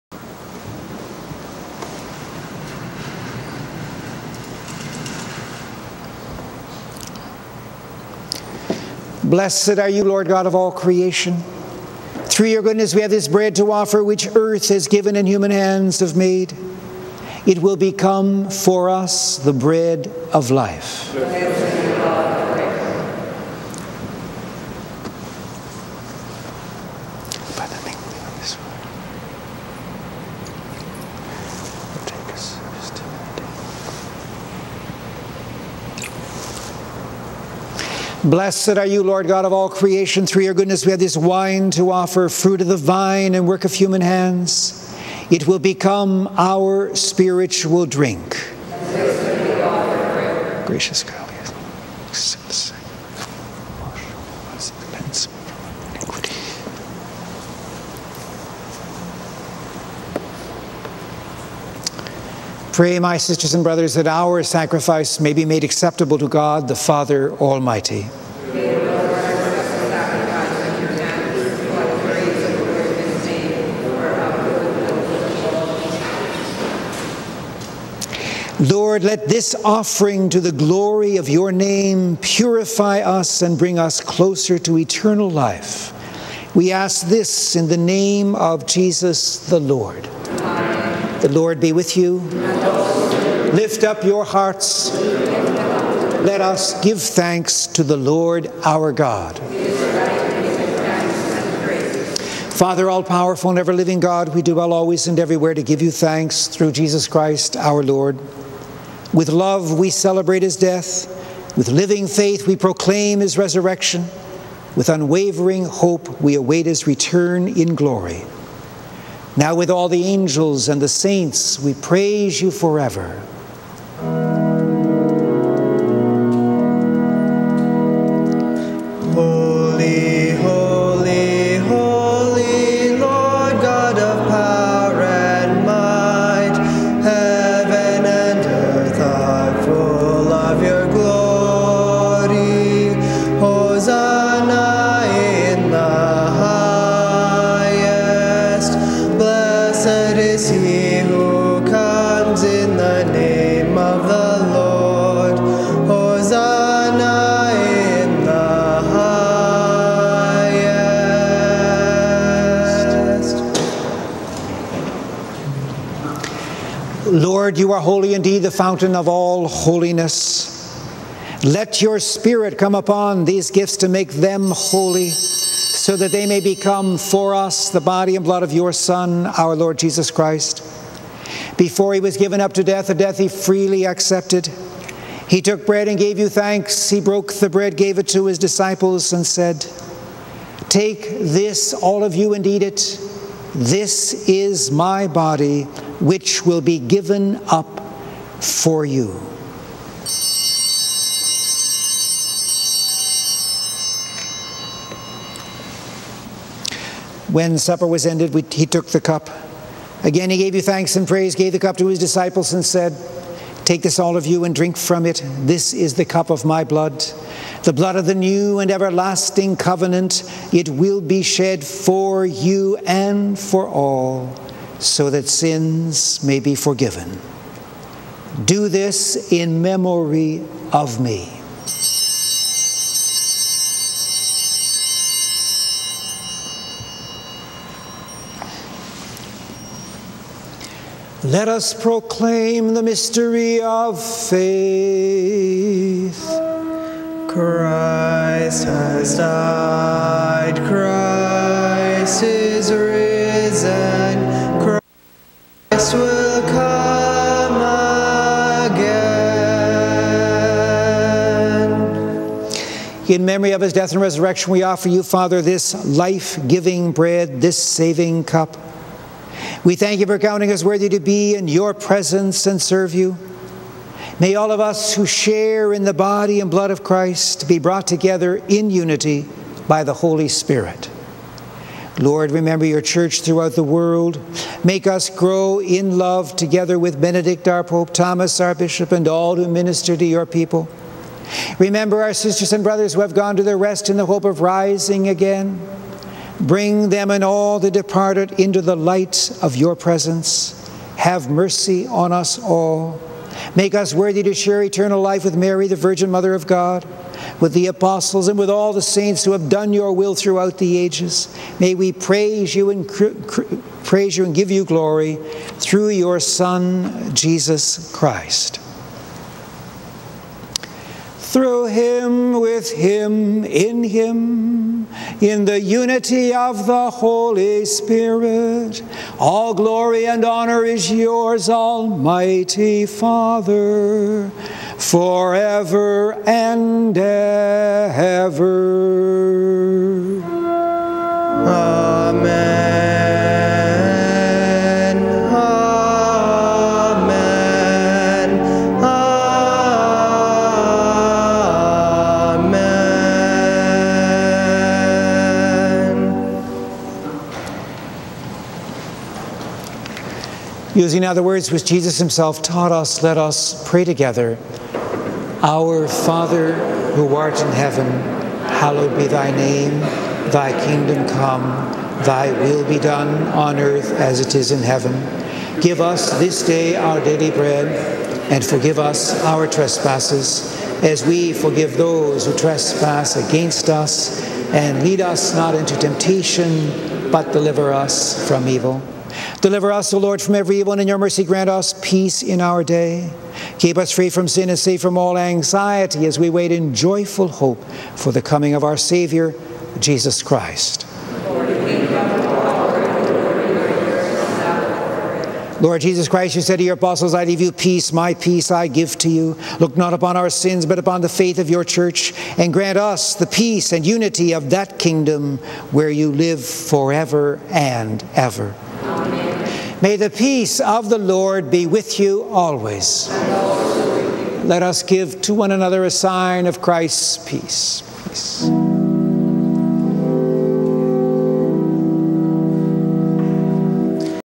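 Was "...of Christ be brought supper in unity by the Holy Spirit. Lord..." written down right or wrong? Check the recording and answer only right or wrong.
wrong.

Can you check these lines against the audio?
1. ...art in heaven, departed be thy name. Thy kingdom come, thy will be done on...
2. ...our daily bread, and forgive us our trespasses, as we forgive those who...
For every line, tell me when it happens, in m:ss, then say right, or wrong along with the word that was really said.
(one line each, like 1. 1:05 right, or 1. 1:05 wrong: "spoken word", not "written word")
1. 6:07 wrong: "hallowed", not "departed"
2. 6:16 right.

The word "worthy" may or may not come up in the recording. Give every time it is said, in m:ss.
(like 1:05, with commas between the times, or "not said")
4:30, 5:03.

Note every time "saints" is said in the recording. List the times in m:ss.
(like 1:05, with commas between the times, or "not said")
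2:00, 5:08.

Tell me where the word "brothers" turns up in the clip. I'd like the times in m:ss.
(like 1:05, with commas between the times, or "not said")
1:03, 4:52.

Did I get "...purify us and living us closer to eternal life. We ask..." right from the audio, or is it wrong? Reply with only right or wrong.
wrong.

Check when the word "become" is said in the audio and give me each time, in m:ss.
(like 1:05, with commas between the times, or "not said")
0:17, 0:45, 2:56.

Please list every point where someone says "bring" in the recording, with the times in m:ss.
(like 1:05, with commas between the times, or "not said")
1:23, 4:56.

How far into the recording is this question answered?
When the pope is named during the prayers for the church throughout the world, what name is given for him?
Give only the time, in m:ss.
4:47.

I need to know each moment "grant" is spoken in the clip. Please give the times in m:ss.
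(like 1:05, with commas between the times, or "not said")
6:31, 6:52.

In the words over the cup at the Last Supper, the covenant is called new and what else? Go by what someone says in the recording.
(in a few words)
Everlasting.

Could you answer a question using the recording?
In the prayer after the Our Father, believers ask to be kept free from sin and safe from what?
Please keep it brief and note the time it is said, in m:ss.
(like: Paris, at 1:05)
All anxiety, at 6:34.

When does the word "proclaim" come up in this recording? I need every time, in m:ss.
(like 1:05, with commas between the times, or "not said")
1:52, 4:01.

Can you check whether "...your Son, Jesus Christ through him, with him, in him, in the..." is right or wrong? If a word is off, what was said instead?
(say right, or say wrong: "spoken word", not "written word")
right.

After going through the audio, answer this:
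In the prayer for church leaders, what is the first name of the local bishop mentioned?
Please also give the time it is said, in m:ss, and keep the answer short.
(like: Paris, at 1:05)
Thomas, at 4:47.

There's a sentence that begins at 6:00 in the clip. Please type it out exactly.
Using other words which Jesus himself taught us, let us pray together.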